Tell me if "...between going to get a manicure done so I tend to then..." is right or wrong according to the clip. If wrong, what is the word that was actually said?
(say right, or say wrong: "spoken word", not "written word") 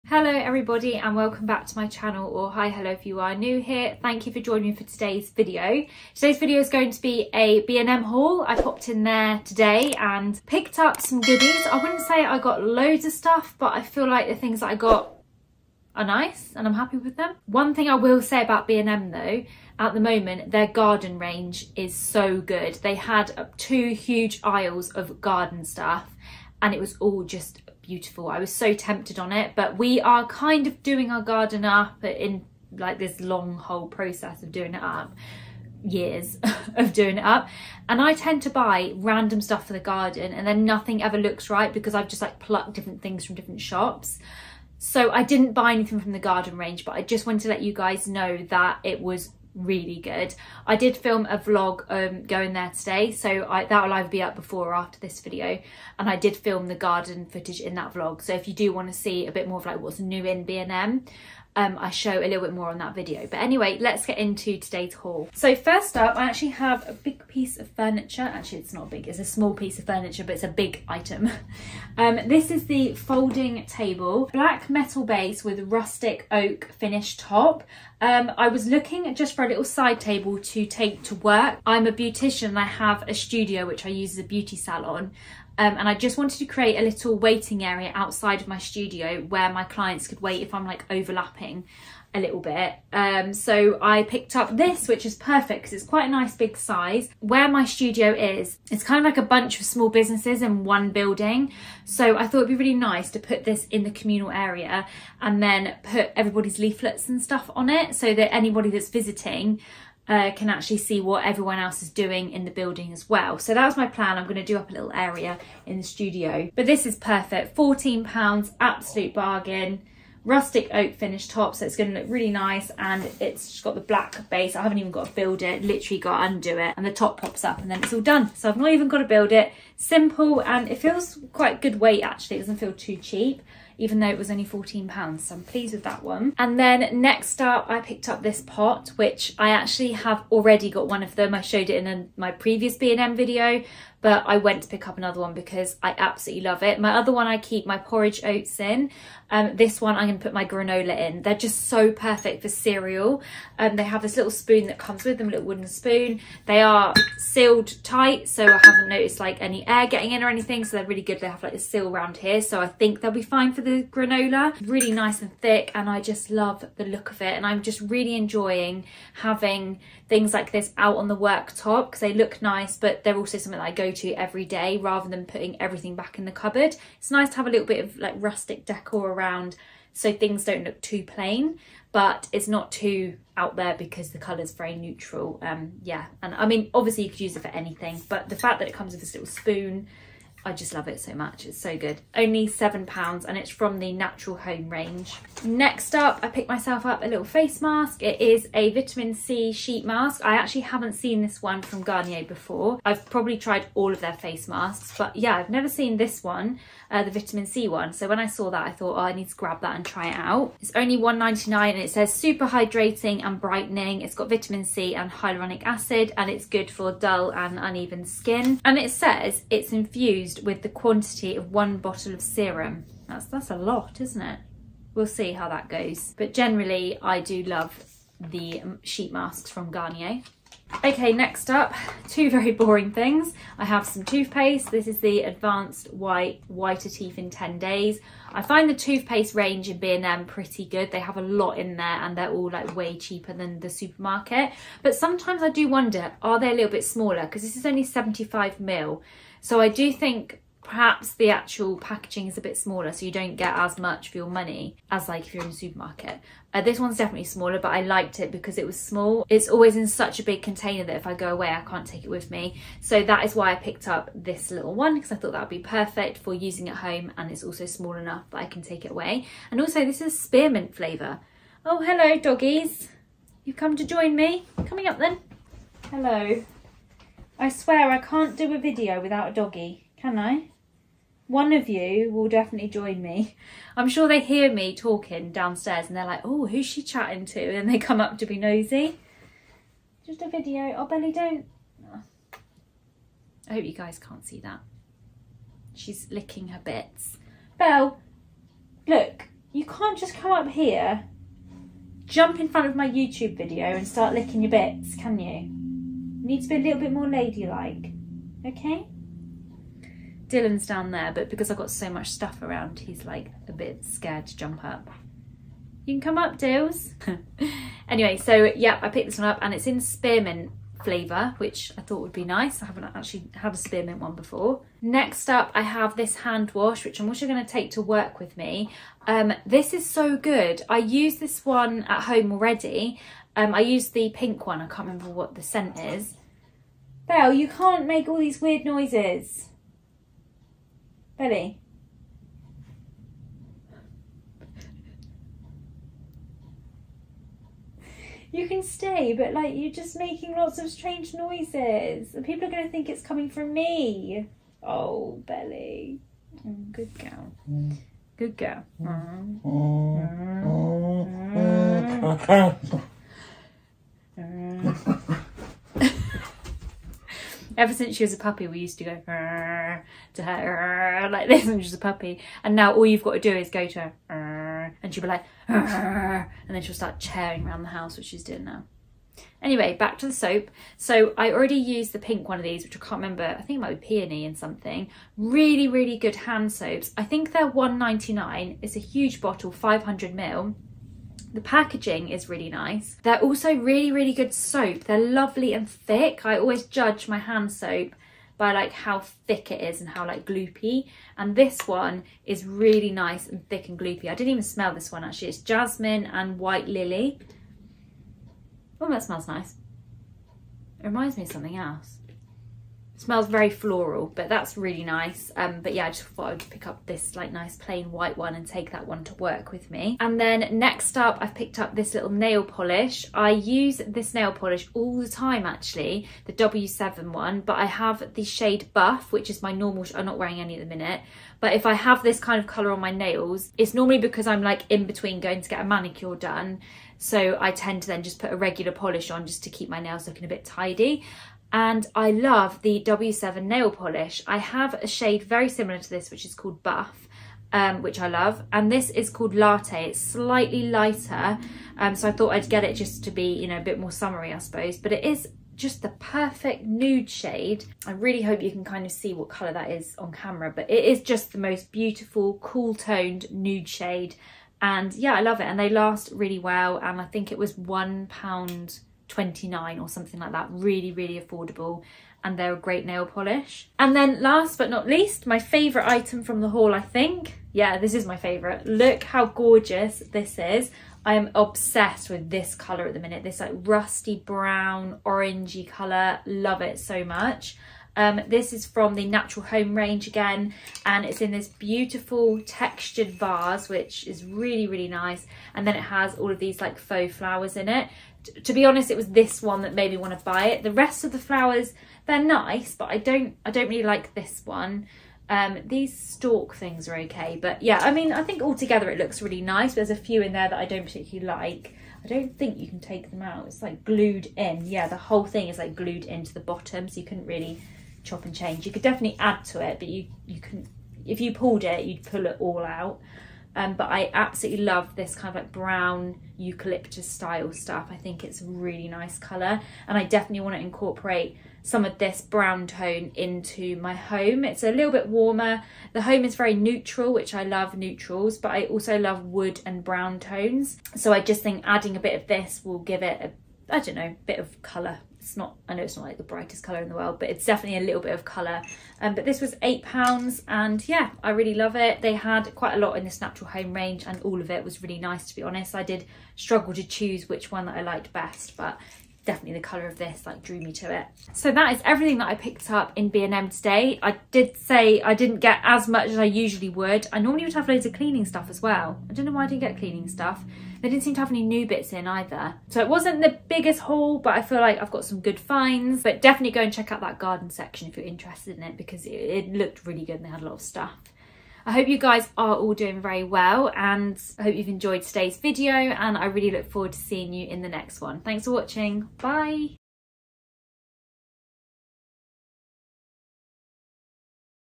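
right.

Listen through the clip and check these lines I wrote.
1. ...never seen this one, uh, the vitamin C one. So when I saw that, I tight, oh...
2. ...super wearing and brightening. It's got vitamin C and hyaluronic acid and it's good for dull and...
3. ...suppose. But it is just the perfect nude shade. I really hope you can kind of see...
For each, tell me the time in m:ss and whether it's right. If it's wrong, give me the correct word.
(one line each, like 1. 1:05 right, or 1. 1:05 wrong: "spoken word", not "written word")
1. 3:25 wrong: "thought", not "tight"
2. 3:32 wrong: "hydrating", not "wearing"
3. 7:34 right.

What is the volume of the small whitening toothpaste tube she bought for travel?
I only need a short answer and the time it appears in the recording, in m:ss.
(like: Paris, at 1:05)
75 ml, at 4:07.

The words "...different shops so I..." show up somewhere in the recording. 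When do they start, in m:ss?
0:43.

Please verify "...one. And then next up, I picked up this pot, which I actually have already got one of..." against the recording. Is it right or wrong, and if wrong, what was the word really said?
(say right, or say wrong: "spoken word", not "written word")
right.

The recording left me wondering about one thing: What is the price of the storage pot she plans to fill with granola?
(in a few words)
£7.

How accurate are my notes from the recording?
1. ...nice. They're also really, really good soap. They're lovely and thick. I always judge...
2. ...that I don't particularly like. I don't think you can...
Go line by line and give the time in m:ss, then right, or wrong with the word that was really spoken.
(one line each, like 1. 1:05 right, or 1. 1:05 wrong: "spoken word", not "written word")
1. 6:32 right
2. 8:30 right.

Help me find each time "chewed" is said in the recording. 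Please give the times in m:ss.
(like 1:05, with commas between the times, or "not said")
not said.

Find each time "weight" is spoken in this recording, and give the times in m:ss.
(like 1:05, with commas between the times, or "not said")
2:11.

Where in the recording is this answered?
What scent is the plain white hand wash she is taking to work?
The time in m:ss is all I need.
6:45.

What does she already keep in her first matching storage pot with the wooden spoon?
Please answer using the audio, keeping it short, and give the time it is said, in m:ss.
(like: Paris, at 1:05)
porridge oats, at 2:27.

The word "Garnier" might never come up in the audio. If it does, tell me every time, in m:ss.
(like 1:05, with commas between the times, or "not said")
3:21, 3:49.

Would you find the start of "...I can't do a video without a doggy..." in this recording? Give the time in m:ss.
4:37.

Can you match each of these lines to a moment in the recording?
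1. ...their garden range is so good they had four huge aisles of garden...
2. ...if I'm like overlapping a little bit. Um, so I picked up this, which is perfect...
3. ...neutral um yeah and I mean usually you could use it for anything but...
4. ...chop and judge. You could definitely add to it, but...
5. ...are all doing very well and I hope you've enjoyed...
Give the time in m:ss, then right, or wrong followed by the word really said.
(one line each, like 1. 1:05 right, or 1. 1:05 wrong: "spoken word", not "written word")
1. 0:20 wrong: "two", not "four"
2. 1:30 right
3. 3:04 wrong: "obviously", not "usually"
4. 8:38 wrong: "change", not "judge"
5. 9:42 right.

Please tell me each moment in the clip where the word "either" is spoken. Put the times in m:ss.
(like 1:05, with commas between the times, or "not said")
0:53, 9:32.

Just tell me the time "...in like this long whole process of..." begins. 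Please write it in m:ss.
0:32.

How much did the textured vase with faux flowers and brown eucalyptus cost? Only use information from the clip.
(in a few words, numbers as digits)
£8.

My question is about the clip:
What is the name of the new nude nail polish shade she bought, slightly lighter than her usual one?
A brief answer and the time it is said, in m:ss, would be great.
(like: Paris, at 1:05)
Latte, at 7:29.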